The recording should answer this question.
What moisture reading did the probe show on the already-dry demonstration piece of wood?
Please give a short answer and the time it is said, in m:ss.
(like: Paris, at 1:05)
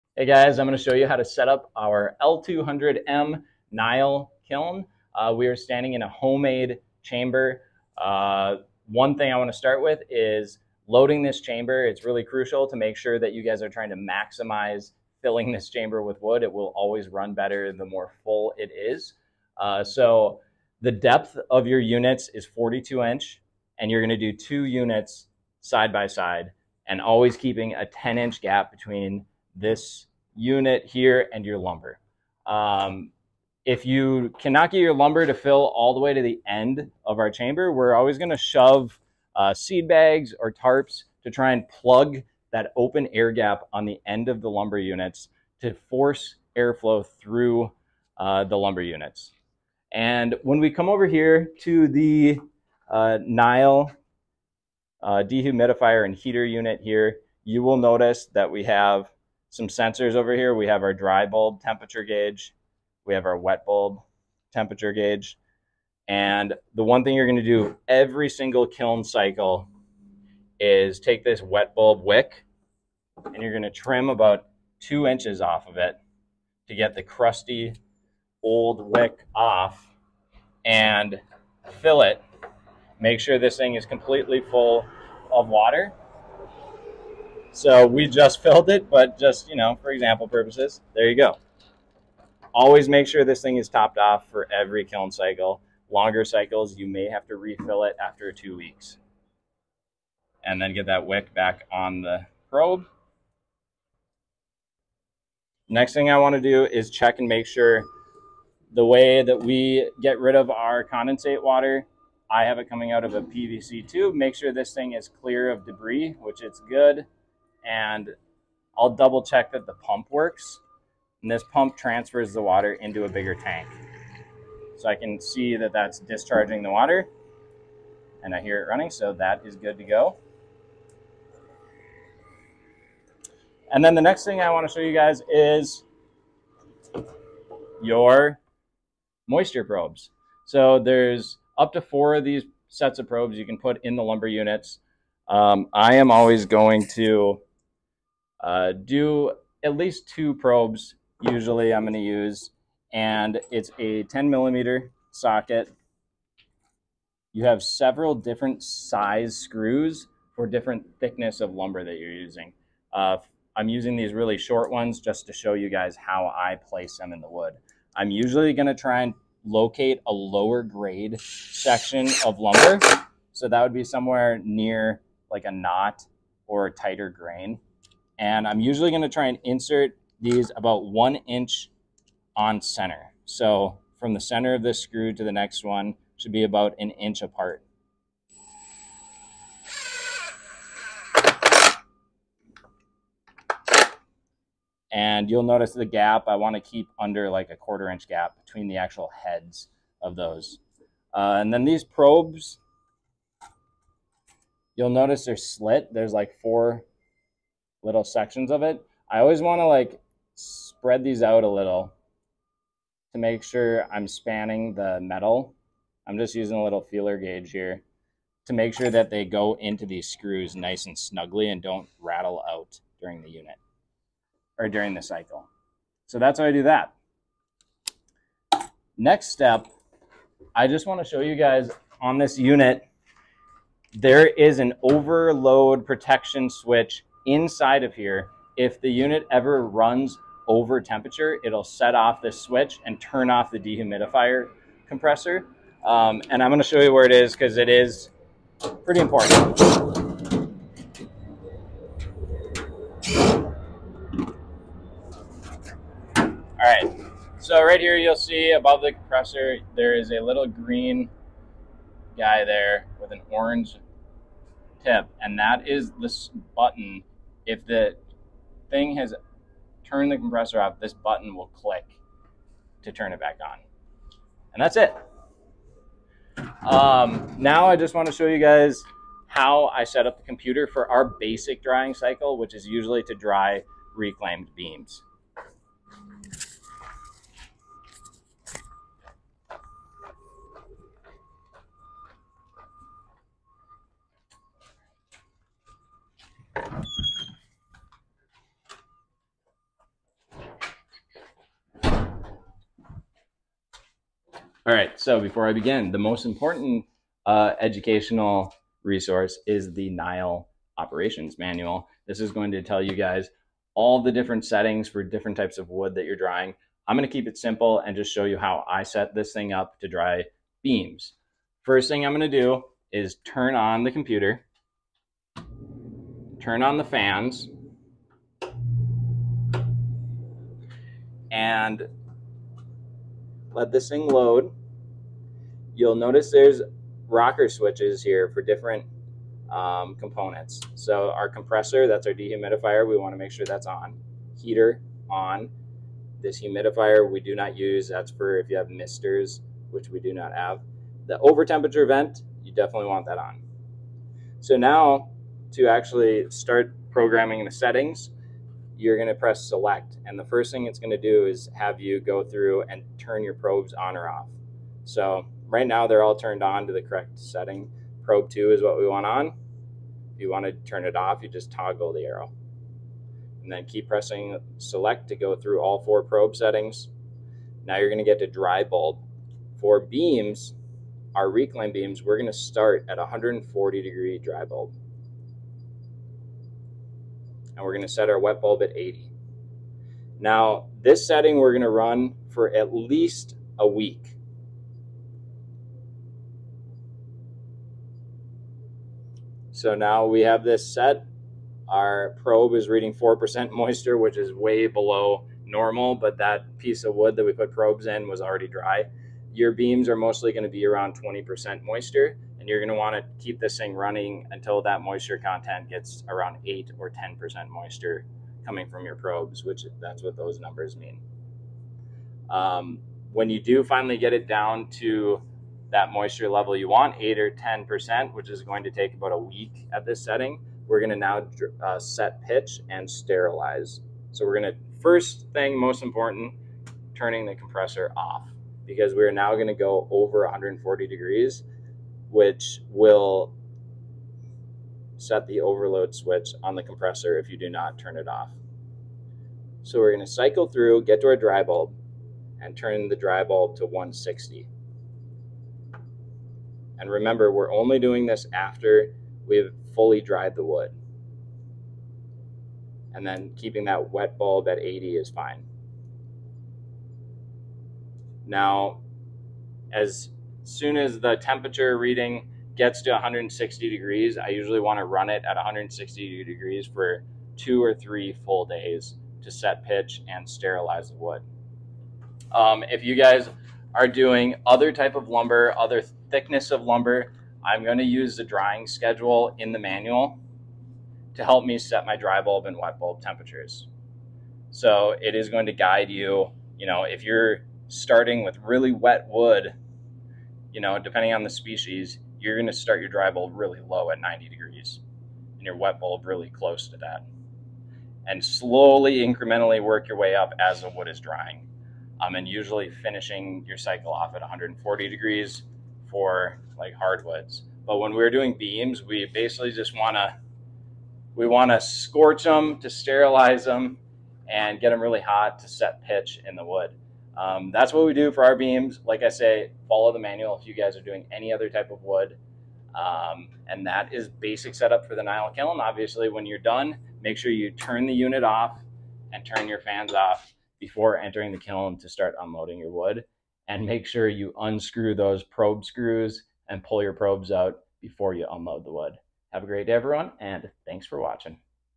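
4%, at 6:42.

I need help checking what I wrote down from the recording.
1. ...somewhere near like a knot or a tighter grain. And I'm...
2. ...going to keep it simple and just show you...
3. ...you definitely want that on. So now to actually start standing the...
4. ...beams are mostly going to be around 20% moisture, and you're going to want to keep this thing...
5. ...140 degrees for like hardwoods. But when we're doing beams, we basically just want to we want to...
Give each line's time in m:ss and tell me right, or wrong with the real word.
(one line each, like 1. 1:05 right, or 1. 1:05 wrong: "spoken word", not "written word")
1. 2:53 right
2. 5:16 right
3. 5:52 wrong: "programming", not "standing"
4. 6:49 right
5. 8:34 right.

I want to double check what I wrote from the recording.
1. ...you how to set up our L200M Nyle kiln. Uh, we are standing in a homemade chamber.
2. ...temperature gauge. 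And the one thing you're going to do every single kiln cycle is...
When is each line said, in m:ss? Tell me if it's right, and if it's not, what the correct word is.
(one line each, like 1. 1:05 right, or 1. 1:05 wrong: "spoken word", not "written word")
1. 0:00 right
2. 1:04 right.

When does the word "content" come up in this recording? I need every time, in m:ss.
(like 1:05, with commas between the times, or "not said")
6:55.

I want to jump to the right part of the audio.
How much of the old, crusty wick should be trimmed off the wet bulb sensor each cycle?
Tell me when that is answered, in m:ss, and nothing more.
1:14.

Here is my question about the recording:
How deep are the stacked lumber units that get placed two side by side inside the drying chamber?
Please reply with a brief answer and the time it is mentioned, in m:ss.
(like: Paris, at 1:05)
42 inch, at 0:22.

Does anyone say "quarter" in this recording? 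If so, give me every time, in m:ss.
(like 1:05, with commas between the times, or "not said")
3:17.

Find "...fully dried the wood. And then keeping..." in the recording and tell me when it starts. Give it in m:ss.
7:39.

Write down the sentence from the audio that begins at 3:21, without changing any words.
Uh, and then these probes, you'll notice they're slit.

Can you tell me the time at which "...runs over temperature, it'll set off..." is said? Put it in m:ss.
3:59.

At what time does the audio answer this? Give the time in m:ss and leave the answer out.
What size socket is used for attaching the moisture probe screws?
2:34.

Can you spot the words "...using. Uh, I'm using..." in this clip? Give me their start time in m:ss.
2:42.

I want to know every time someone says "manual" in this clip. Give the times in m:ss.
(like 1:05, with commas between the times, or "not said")
5:11, 8:09, 8:49.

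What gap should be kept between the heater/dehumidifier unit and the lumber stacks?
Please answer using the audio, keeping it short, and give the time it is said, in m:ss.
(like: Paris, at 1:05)
10 inch, at 0:27.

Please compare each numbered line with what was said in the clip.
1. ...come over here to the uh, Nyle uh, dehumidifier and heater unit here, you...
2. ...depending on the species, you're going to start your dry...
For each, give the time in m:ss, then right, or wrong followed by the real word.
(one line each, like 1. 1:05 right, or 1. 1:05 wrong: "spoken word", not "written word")
1. 0:50 right
2. 8:20 right.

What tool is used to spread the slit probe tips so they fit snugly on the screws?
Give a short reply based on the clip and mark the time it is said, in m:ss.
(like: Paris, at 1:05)
feeler gauge, at 3:36.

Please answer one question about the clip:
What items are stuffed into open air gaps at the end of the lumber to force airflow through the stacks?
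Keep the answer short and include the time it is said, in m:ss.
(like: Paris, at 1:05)
seed bags or tarps, at 0:39.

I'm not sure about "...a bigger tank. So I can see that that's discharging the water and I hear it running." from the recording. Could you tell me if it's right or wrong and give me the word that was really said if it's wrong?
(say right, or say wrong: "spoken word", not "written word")
right.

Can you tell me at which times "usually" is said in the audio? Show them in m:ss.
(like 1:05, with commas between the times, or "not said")
2:31, 2:48, 2:58, 4:42, 7:54, 8:32.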